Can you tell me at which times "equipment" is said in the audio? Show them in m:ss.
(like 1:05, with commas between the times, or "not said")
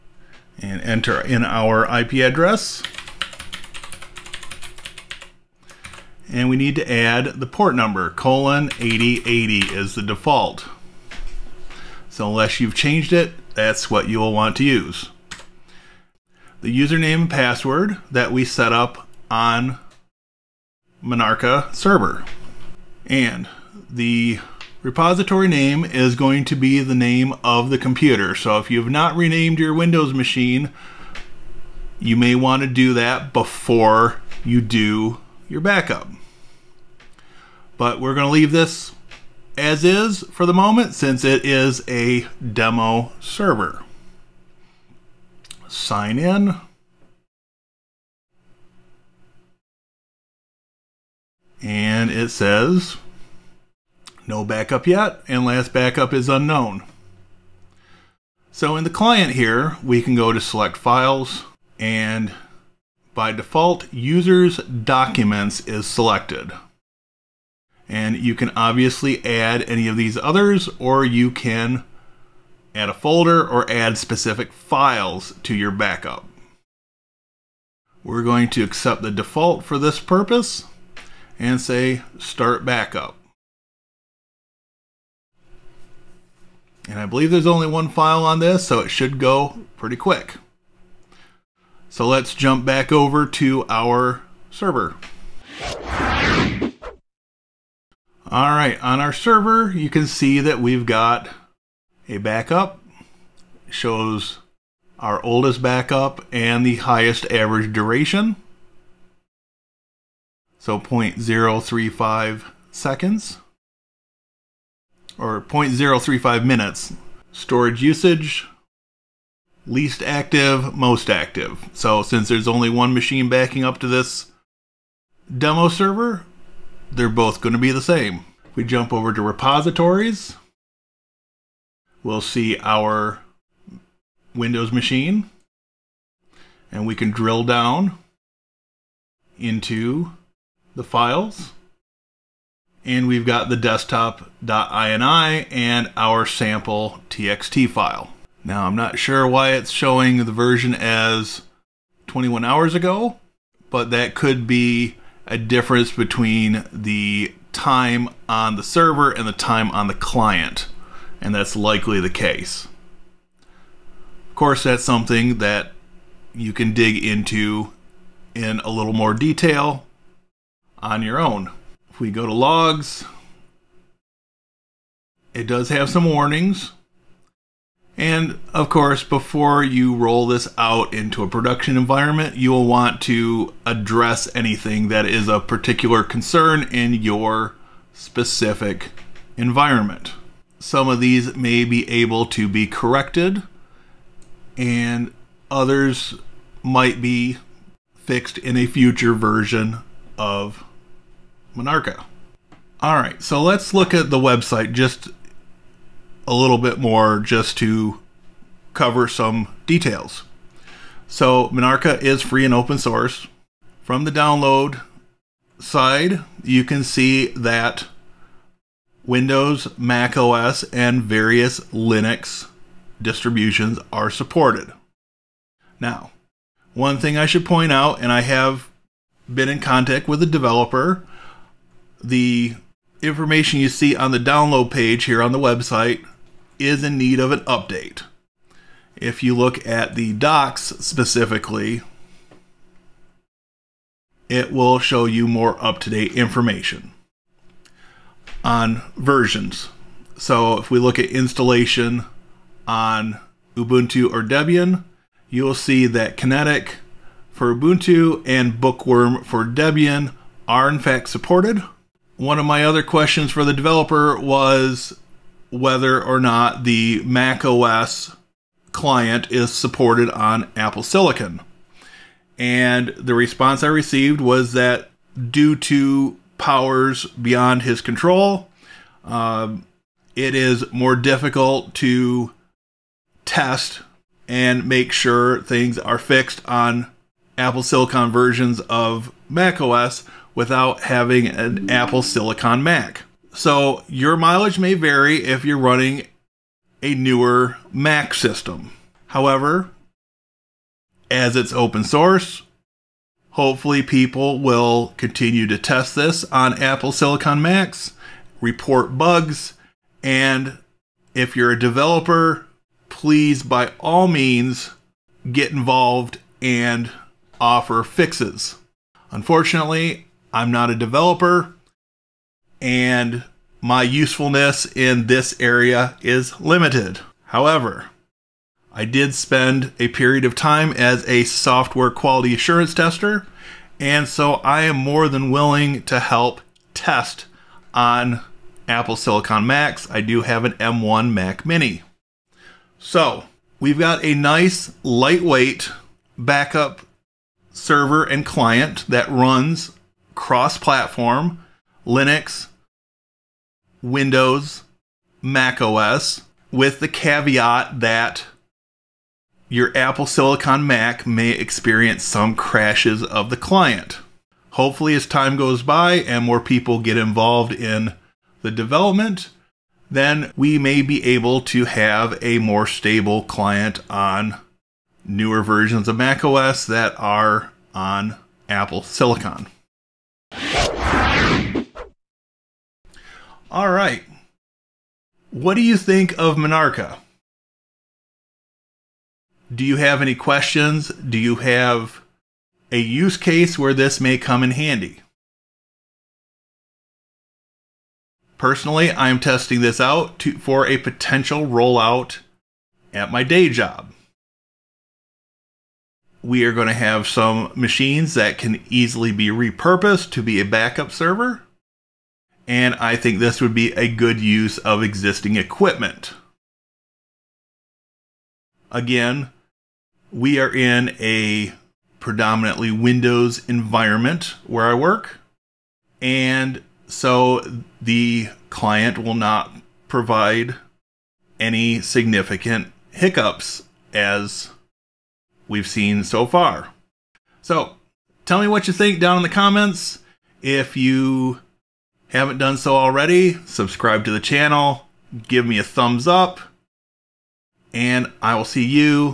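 6:55.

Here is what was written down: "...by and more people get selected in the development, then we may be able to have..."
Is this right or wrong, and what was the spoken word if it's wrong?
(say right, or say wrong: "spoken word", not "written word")
wrong: "involved", not "selected".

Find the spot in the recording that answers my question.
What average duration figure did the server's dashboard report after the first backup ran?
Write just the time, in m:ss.
1:50.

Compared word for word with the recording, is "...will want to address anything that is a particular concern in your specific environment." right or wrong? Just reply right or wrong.
right.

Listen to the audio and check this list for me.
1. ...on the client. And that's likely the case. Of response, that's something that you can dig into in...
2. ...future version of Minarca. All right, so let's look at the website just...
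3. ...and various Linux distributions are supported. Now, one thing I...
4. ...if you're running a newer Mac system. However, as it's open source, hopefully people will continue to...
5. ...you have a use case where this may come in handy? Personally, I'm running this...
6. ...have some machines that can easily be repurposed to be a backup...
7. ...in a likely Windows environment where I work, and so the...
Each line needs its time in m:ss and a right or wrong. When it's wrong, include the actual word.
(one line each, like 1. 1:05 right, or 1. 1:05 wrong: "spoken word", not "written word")
1. 2:39 wrong: "course", not "response"
2. 3:18 right
3. 3:40 right
4. 4:55 right
5. 6:31 wrong: "testing", not "running"
6. 6:46 right
7. 7:00 wrong: "predominantly", not "likely".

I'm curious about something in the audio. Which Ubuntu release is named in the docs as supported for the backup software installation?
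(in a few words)
Kinetic.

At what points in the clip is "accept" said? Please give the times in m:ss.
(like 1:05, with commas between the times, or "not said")
1:18.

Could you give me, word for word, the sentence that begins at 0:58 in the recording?
So in the client here, we can go to select files and by default, users documents is selected.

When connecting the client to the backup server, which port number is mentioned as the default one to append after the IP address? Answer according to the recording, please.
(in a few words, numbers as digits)
8080.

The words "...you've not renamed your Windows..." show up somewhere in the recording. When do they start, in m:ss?
0:28.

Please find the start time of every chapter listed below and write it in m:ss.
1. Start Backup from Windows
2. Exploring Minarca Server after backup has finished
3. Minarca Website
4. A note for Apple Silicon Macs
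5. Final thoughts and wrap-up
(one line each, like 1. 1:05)
1. 1:20
2. 1:37
3. 3:21
4. 4:21
5. 6:22.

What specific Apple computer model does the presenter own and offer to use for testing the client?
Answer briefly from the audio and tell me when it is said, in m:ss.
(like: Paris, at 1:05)
M1 Mac Mini, at 5:40.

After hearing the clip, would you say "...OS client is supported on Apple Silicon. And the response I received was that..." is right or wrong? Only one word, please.
right.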